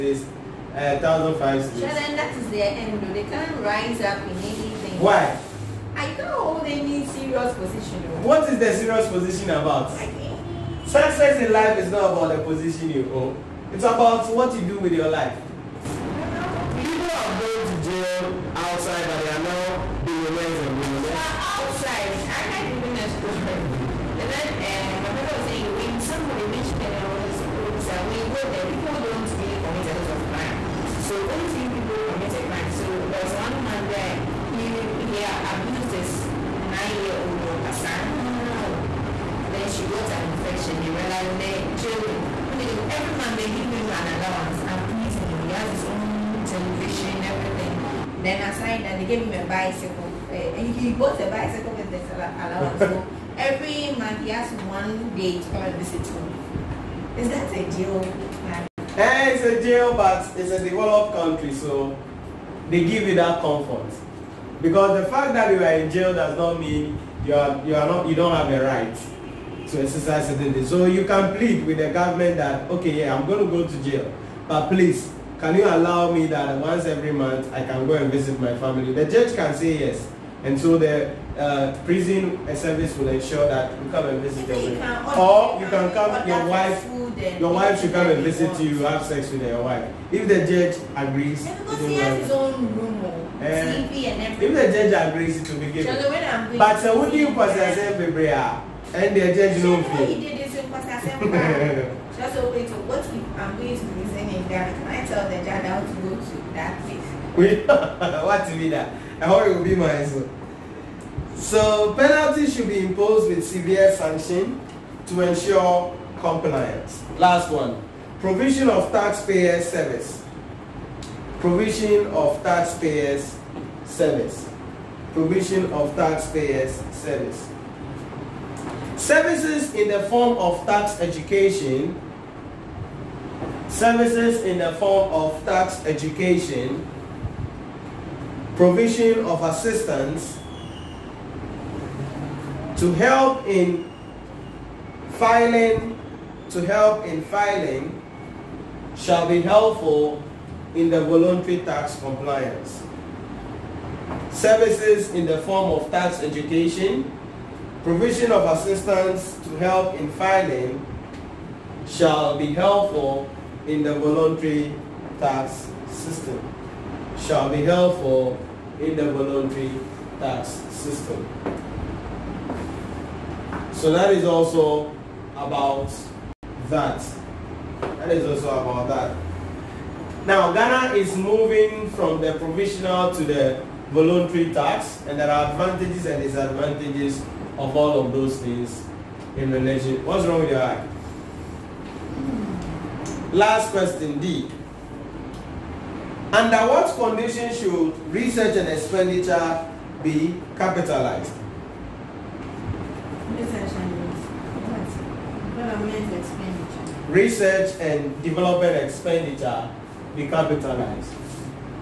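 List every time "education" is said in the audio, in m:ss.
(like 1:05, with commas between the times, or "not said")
2:11, 2:15, 2:36.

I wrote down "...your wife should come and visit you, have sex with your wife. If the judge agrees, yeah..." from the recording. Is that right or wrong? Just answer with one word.
right.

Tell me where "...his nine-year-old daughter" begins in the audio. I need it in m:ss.
0:35.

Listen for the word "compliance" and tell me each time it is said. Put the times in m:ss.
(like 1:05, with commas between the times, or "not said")
1:56, 2:32.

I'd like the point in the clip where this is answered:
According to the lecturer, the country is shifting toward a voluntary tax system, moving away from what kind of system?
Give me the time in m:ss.
3:02.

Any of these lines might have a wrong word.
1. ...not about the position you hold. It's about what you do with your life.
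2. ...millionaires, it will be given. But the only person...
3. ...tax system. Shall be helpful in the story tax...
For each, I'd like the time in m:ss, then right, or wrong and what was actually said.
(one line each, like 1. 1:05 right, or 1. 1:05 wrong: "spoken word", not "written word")
1. 0:11 right
2. 1:35 wrong: "agrees", not "millionaires"
3. 2:45 wrong: "voluntary", not "story".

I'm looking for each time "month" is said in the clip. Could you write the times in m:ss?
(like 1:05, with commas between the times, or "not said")
0:43, 0:53, 1:17.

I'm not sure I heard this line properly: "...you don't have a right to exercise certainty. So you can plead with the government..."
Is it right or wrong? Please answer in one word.
right.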